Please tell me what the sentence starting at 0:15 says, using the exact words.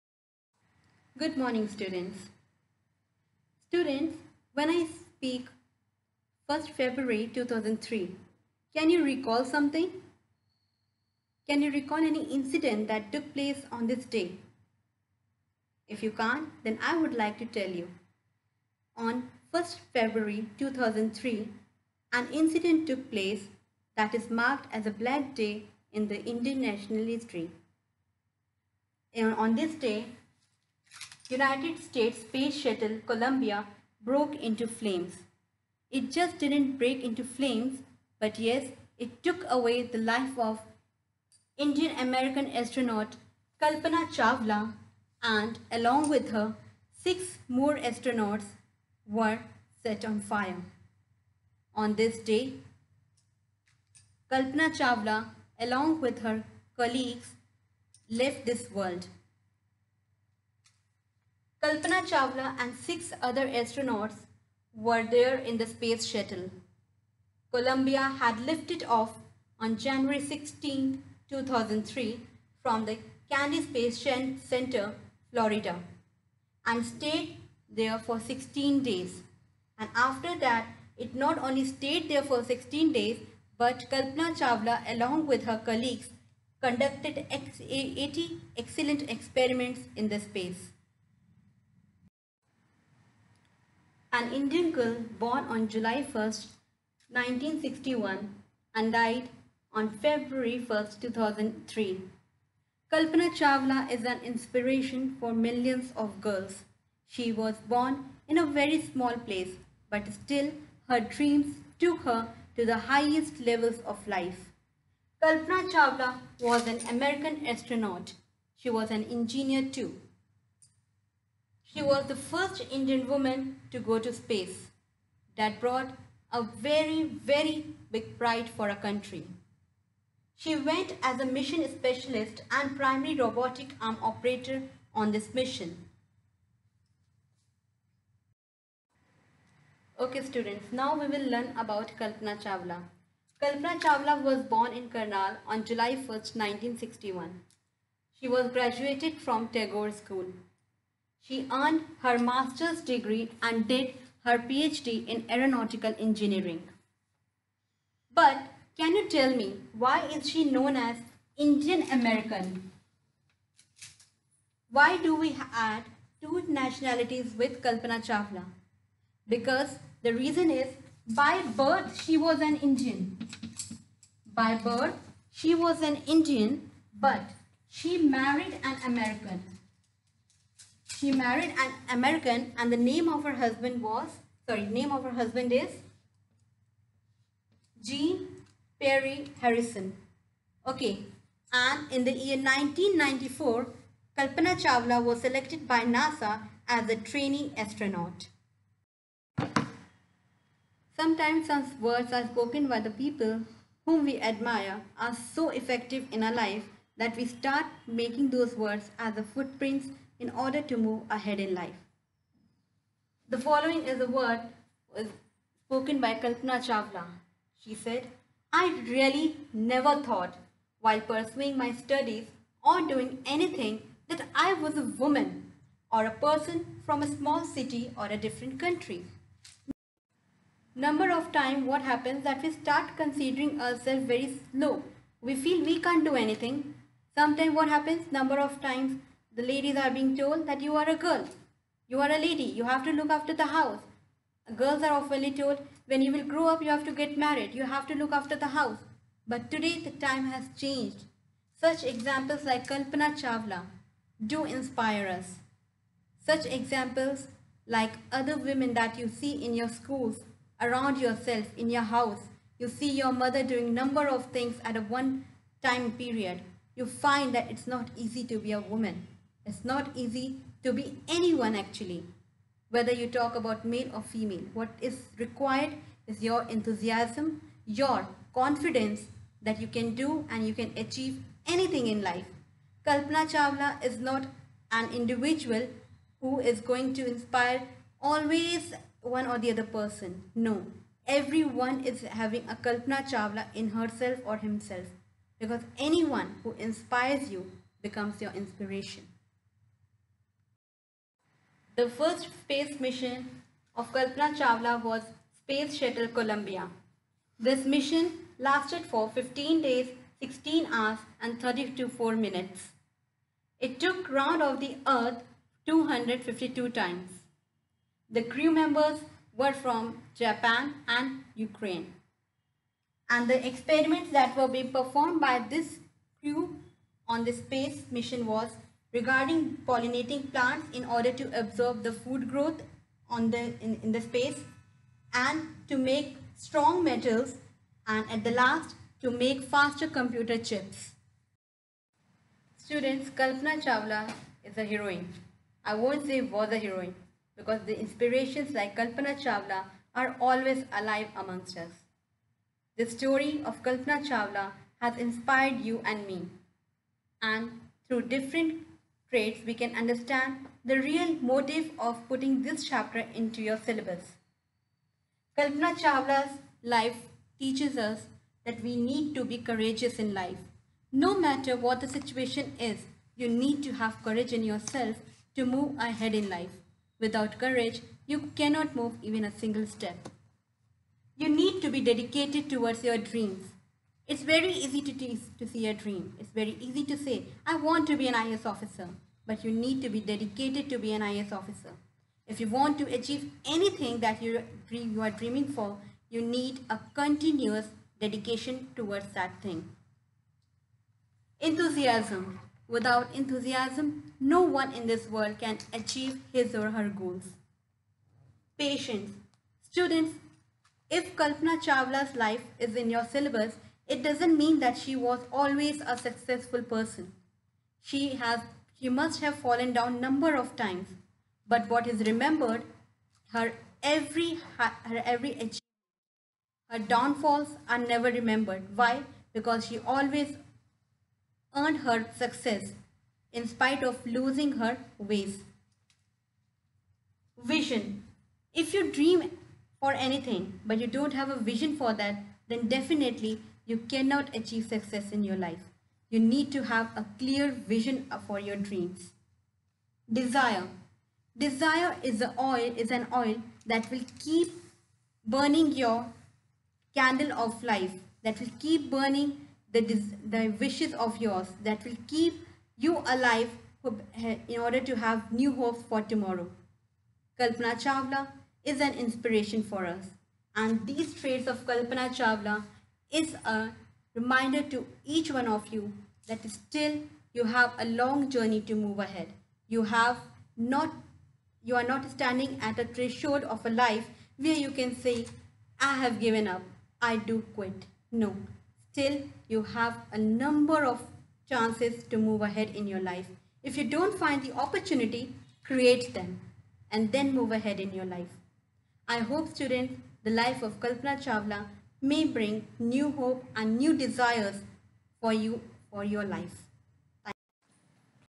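If you can't, then I would like to tell you.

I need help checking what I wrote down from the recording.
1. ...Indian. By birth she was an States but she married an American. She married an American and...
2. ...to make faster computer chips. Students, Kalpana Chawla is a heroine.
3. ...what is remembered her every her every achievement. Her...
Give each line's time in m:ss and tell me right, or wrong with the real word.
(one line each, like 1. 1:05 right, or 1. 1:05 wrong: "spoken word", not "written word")
1. 2:52 wrong: "Indian", not "States"
2. 5:39 right
3. 7:01 right.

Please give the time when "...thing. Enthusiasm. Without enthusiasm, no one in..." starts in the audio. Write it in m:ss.
6:39.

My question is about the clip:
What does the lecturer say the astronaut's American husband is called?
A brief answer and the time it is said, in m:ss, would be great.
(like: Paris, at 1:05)
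Jean Perry Harrison, at 3:07.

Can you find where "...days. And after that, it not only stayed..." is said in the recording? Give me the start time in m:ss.
1:18.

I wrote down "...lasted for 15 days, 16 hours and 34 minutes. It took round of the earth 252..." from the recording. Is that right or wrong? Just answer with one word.
right.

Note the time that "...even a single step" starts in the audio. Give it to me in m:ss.
6:19.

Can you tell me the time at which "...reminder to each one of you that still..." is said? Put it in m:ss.
7:54.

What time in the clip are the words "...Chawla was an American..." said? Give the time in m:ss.
1:55.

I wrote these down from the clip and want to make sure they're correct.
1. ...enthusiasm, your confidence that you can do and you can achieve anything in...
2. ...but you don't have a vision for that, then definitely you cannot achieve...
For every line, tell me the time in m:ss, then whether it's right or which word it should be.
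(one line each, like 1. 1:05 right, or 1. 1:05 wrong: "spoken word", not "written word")
1. 4:36 right
2. 7:20 right.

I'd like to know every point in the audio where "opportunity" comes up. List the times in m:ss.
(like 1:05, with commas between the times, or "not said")
8:14.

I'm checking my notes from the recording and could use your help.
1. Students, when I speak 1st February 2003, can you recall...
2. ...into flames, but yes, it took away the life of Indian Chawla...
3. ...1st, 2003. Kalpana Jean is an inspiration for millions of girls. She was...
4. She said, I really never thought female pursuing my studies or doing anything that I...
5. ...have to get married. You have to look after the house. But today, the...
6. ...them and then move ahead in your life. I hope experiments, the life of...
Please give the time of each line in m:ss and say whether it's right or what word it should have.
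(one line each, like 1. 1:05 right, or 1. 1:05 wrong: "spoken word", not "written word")
1. 0:03 right
2. 0:37 wrong: "American", not "Chawla"
3. 1:40 wrong: "Chawla", not "Jean"
4. 3:37 wrong: "while", not "female"
5. 4:06 right
6. 8:16 wrong: "students", not "experiments".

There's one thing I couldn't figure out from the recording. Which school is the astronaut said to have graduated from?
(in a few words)
Tagore School.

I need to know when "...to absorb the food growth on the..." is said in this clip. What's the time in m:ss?
5:31.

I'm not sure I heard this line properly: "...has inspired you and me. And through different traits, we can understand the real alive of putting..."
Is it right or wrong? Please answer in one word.
wrong.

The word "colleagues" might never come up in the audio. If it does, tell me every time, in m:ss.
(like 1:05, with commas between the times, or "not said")
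0:56, 1:25.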